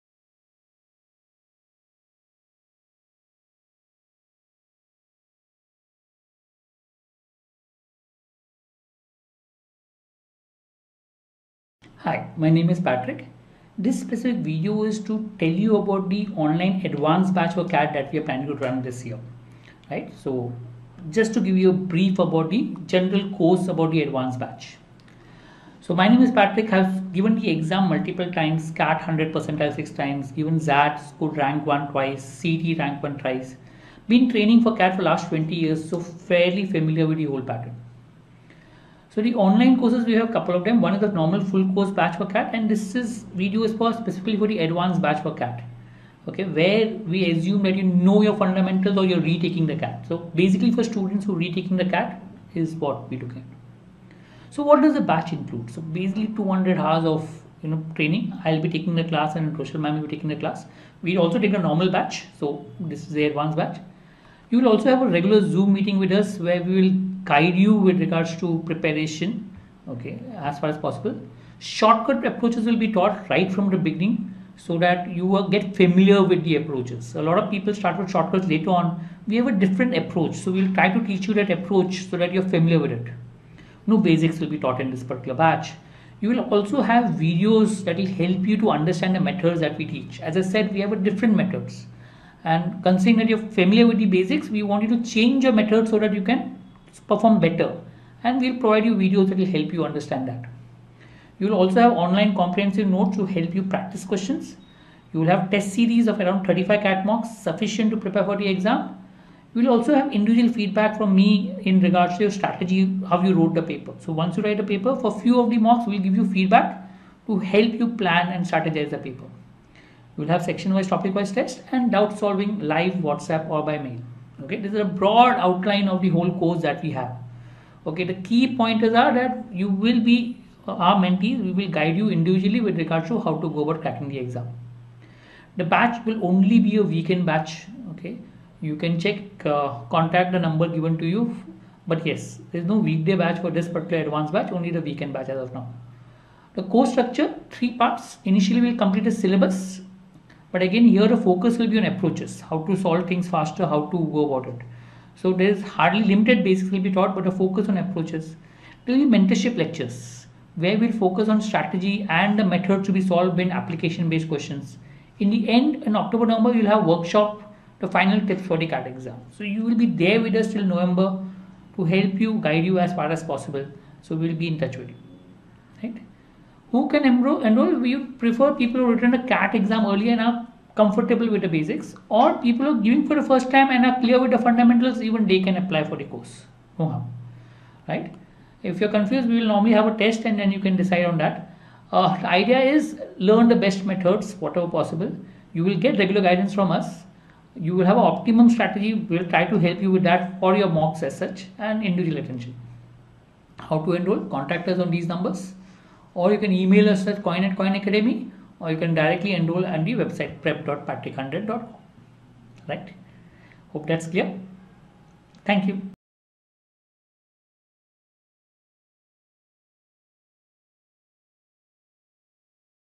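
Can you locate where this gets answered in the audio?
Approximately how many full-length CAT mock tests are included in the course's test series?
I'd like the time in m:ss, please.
1:46.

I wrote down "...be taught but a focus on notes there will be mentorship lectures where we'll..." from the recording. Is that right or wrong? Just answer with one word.
wrong.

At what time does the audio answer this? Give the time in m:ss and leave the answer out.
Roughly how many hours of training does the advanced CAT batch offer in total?
0:56.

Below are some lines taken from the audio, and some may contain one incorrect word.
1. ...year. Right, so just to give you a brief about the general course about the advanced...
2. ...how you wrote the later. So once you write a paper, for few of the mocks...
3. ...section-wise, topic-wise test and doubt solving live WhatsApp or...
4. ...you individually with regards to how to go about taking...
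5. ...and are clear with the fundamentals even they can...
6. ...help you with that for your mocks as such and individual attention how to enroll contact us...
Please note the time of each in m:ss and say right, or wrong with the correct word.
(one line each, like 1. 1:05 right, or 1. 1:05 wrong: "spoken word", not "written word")
1. 0:19 right
2. 1:53 wrong: "paper", not "later"
3. 2:00 right
4. 2:11 wrong: "cracking", not "taking"
5. 3:03 right
6. 3:19 right.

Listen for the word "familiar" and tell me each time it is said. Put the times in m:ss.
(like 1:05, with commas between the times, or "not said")
0:36, 1:15, 1:22, 1:33.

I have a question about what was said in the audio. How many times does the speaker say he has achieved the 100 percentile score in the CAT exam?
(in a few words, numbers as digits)
6.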